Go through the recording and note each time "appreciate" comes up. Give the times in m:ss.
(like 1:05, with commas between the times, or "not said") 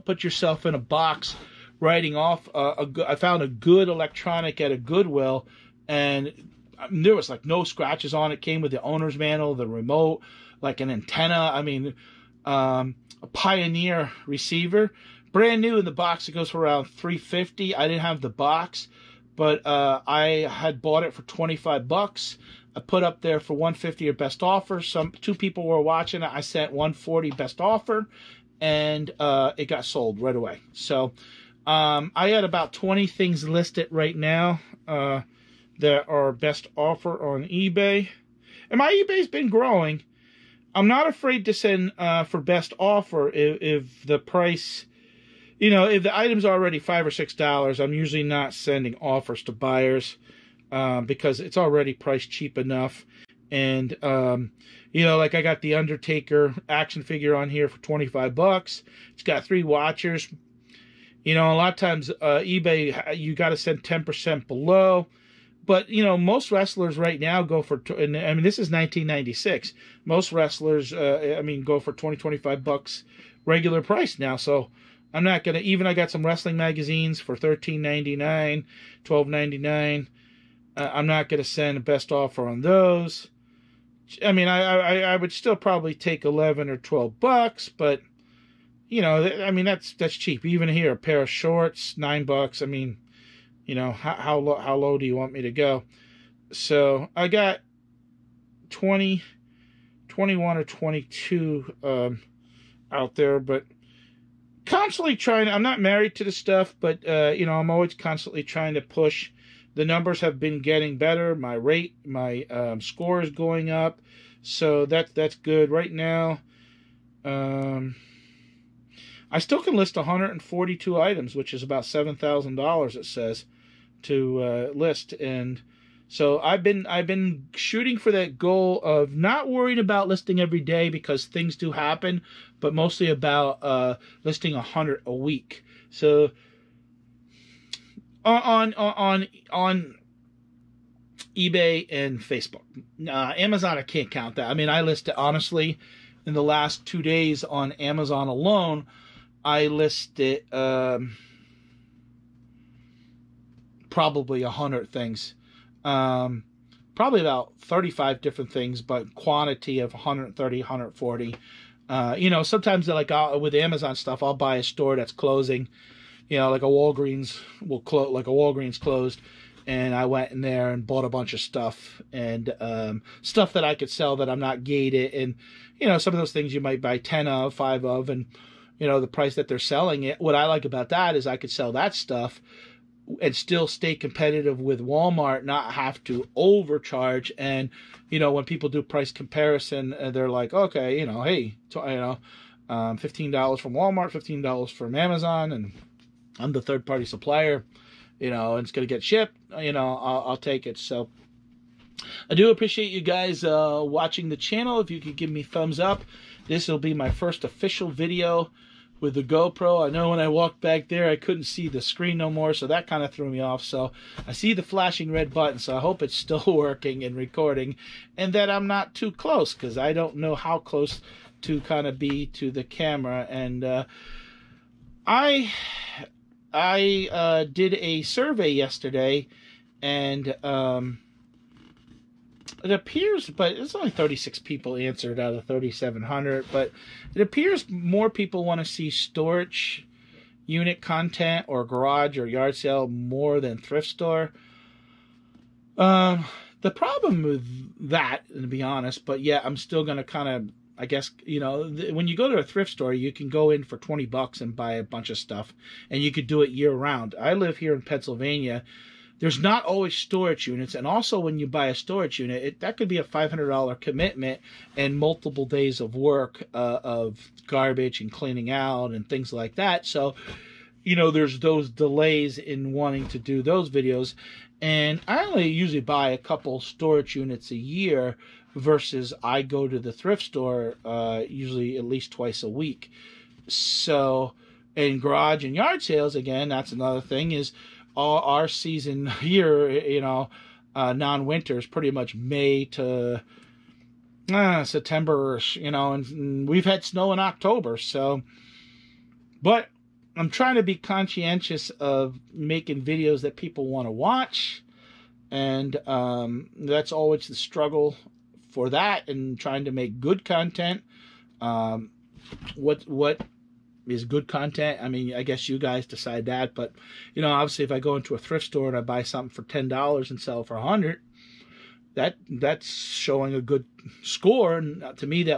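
3:22.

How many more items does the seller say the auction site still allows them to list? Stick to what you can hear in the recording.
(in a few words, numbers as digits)
142.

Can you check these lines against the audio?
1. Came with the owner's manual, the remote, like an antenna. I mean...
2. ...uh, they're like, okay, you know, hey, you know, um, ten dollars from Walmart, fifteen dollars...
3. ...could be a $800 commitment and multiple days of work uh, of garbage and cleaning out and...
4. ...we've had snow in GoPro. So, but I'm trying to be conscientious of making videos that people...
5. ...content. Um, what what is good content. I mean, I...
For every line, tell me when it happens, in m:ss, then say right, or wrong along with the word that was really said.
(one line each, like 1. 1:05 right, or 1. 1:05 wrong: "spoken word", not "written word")
1. 0:08 right
2. 3:09 wrong: "fifteen", not "ten"
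3. 4:22 wrong: "500", not "800"
4. 4:56 wrong: "October", not "GoPro"
5. 5:10 right.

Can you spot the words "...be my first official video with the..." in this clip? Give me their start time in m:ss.
3:26.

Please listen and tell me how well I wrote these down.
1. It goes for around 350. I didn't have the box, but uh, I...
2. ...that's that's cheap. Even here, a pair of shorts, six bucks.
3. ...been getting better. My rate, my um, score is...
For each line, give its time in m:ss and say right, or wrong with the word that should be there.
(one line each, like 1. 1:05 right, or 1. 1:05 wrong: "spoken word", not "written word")
1. 0:16 right
2. 1:29 wrong: "nine", not "six"
3. 1:50 right.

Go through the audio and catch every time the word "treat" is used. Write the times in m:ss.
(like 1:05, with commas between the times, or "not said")
not said.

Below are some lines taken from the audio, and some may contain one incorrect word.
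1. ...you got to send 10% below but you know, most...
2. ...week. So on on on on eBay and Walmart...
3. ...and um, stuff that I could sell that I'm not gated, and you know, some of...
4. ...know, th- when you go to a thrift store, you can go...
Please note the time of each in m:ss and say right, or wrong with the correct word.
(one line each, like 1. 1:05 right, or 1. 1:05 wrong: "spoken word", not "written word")
1. 1:03 right
2. 2:15 wrong: "Facebook", not "Walmart"
3. 2:52 right
4. 4:11 right.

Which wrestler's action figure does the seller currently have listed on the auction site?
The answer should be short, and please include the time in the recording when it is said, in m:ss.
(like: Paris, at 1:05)
Undertaker, at 0:55.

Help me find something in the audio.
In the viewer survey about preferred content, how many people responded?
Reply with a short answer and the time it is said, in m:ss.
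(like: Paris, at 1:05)
36, at 3:53.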